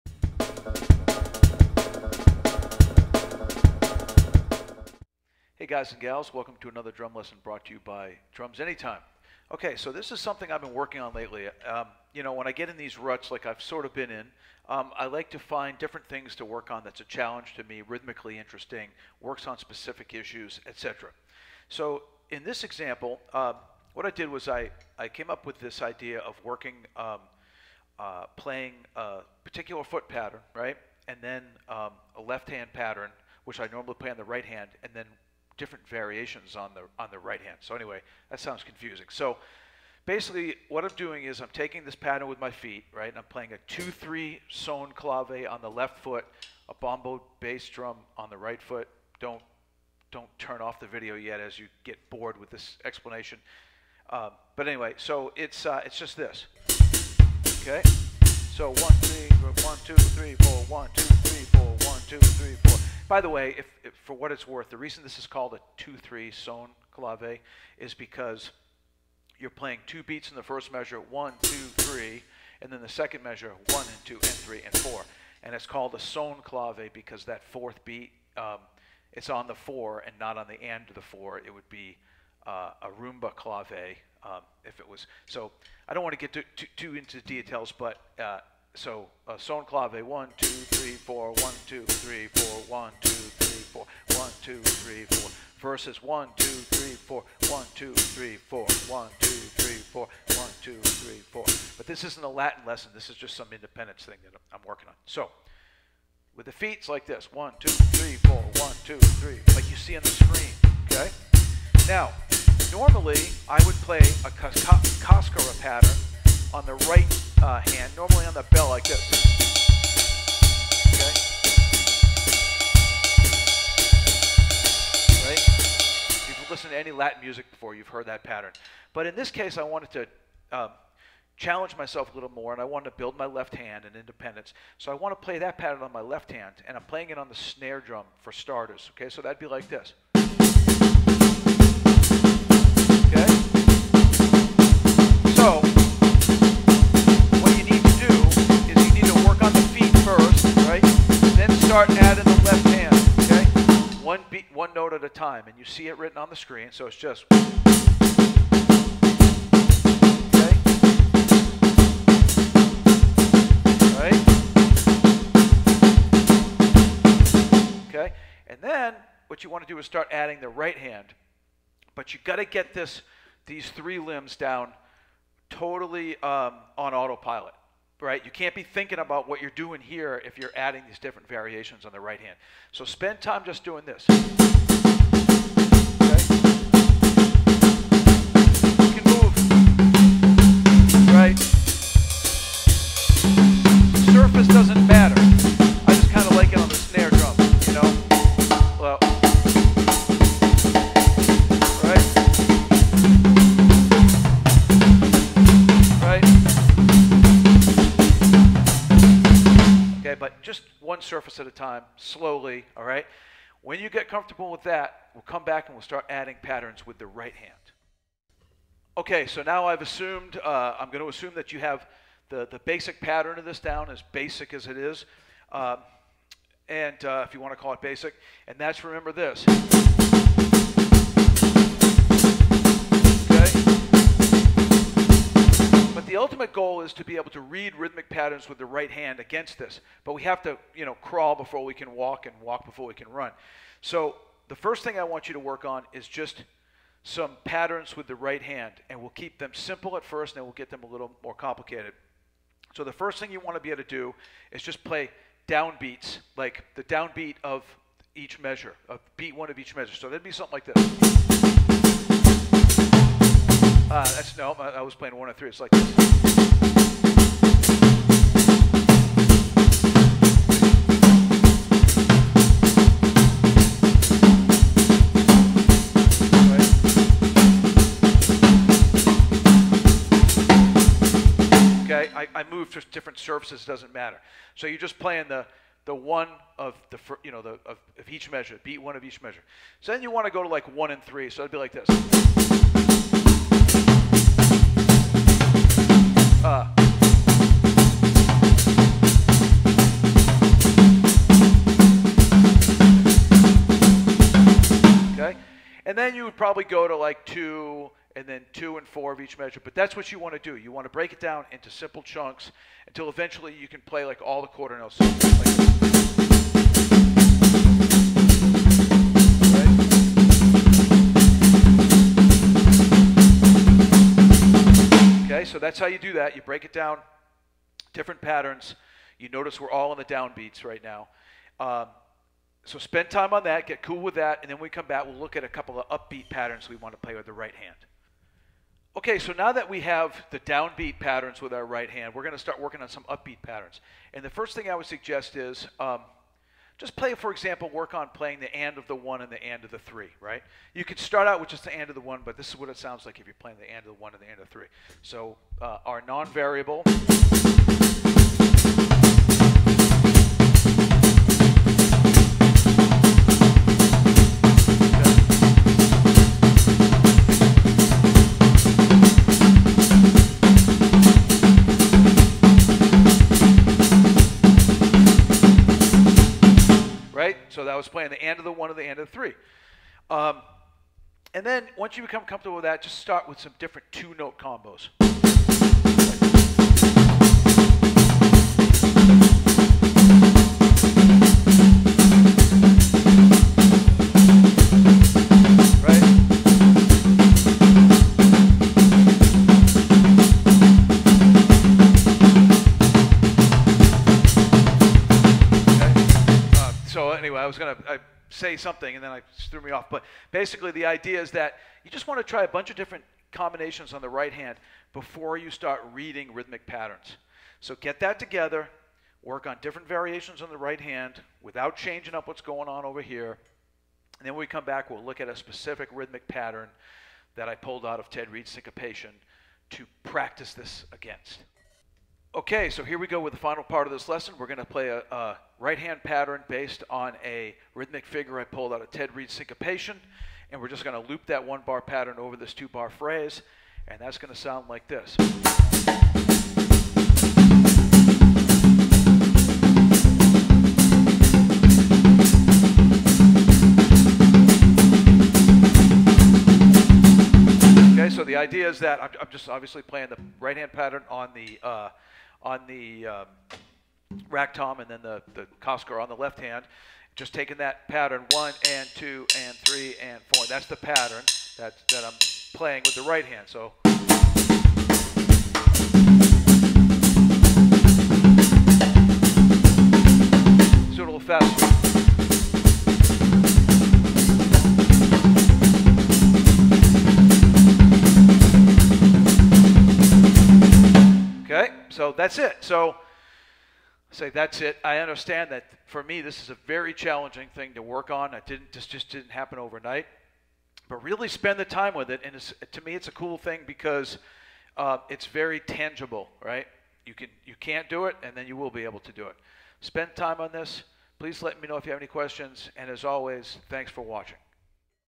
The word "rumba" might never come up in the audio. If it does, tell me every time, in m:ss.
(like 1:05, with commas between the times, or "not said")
1:22.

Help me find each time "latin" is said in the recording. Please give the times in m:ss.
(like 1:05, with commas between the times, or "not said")
1:42, 2:06.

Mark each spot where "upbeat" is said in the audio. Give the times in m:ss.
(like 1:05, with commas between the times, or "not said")
5:35, 5:43.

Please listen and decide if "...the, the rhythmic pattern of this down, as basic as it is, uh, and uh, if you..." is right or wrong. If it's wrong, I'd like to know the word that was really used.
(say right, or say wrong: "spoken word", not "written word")
wrong: "basic", not "rhythmic".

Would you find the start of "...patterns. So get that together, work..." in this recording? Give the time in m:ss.
6:56.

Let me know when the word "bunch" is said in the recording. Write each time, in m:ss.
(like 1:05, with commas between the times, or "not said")
6:52.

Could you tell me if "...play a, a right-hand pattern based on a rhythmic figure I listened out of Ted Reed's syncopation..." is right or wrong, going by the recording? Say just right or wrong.
wrong.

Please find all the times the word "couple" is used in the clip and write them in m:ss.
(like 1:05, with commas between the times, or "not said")
5:35.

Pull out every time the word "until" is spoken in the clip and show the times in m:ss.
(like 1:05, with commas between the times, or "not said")
5:12.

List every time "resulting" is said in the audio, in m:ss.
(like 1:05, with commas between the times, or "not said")
not said.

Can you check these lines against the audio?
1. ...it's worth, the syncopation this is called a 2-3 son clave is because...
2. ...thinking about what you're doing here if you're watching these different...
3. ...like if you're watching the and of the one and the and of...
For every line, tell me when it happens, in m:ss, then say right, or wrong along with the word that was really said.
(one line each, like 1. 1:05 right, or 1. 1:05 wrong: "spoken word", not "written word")
1. 1:04 wrong: "reason", not "syncopation"
2. 2:58 wrong: "adding", not "watching"
3. 5:53 wrong: "playing", not "watching".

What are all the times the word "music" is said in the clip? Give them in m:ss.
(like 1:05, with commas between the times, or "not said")
2:07.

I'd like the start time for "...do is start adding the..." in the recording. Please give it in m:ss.
2:49.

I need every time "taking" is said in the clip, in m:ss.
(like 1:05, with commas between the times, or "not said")
0:41, 7:47.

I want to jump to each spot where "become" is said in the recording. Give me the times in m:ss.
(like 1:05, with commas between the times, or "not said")
6:22.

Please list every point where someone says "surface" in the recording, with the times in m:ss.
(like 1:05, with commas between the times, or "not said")
3:31, 4:43.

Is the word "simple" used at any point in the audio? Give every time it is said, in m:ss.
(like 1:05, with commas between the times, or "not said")
4:09, 5:11.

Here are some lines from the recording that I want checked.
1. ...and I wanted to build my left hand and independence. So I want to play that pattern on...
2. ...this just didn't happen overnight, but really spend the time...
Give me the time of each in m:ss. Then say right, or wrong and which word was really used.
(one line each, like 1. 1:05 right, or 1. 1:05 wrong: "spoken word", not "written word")
1. 2:12 right
2. 8:18 right.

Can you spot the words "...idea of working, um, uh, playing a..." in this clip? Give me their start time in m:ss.
0:25.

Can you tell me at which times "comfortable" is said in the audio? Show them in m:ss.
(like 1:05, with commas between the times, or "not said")
3:34, 6:22.